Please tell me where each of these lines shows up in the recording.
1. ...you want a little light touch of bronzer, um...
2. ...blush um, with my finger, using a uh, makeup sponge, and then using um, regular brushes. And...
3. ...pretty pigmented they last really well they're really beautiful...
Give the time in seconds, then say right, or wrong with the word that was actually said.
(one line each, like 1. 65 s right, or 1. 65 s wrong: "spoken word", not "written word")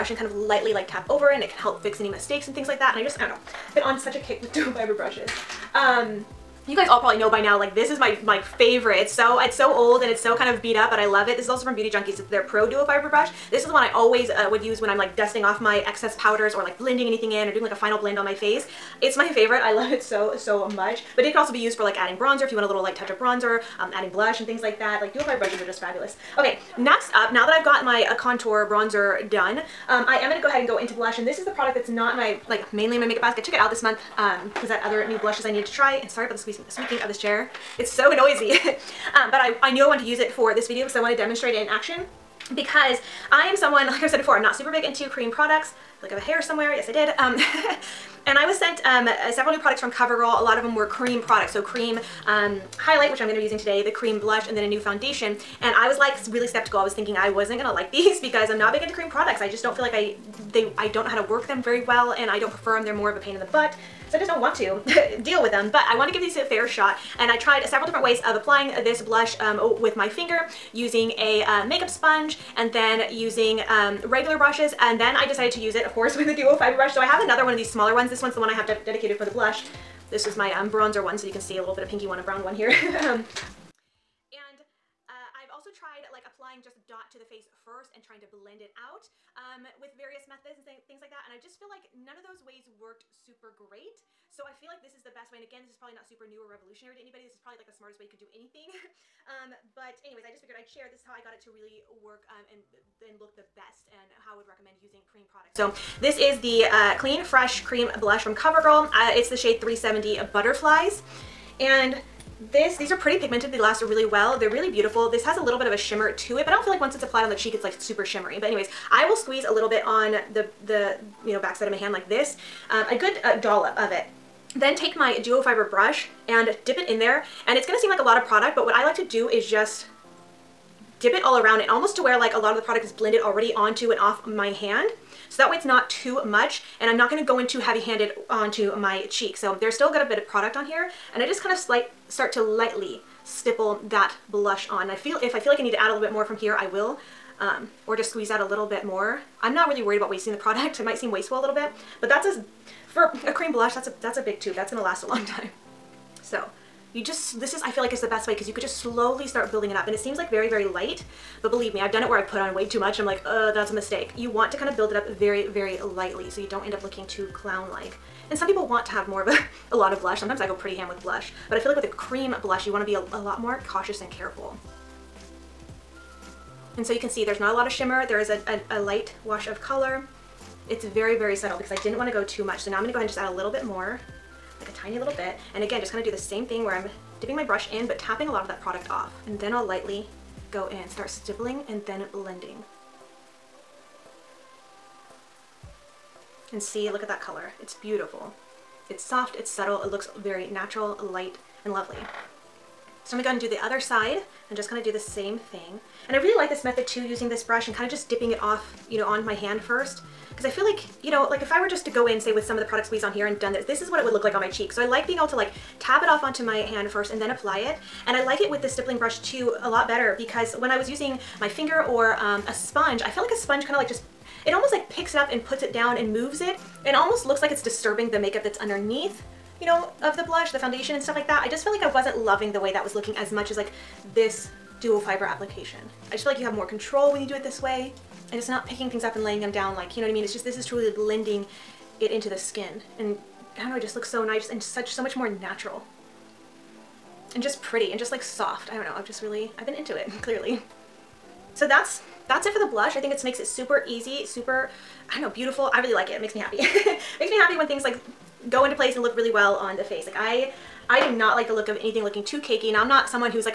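1. 22 s right
2. 68 s right
3. 112 s right.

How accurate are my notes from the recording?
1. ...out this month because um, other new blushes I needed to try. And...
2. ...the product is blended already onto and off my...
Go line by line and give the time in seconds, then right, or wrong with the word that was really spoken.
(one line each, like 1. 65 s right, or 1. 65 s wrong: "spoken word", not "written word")
1. 33 s right
2. 132 s right.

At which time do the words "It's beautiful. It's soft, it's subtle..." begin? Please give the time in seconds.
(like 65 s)
197 s.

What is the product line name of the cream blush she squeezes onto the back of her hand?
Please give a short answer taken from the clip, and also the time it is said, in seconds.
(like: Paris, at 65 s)
Clean Fresh, at 106 s.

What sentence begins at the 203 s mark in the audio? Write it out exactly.
So I'm gonna go and do the other side and just kind of do the same thing.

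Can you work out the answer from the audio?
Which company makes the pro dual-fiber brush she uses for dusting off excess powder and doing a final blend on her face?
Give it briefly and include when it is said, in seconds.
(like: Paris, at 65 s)
Beauty Junkees, at 11 s.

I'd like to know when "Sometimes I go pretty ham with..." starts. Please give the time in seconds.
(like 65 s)
170 s.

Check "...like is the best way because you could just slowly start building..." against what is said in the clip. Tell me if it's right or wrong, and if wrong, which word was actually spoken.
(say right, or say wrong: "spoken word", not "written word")
right.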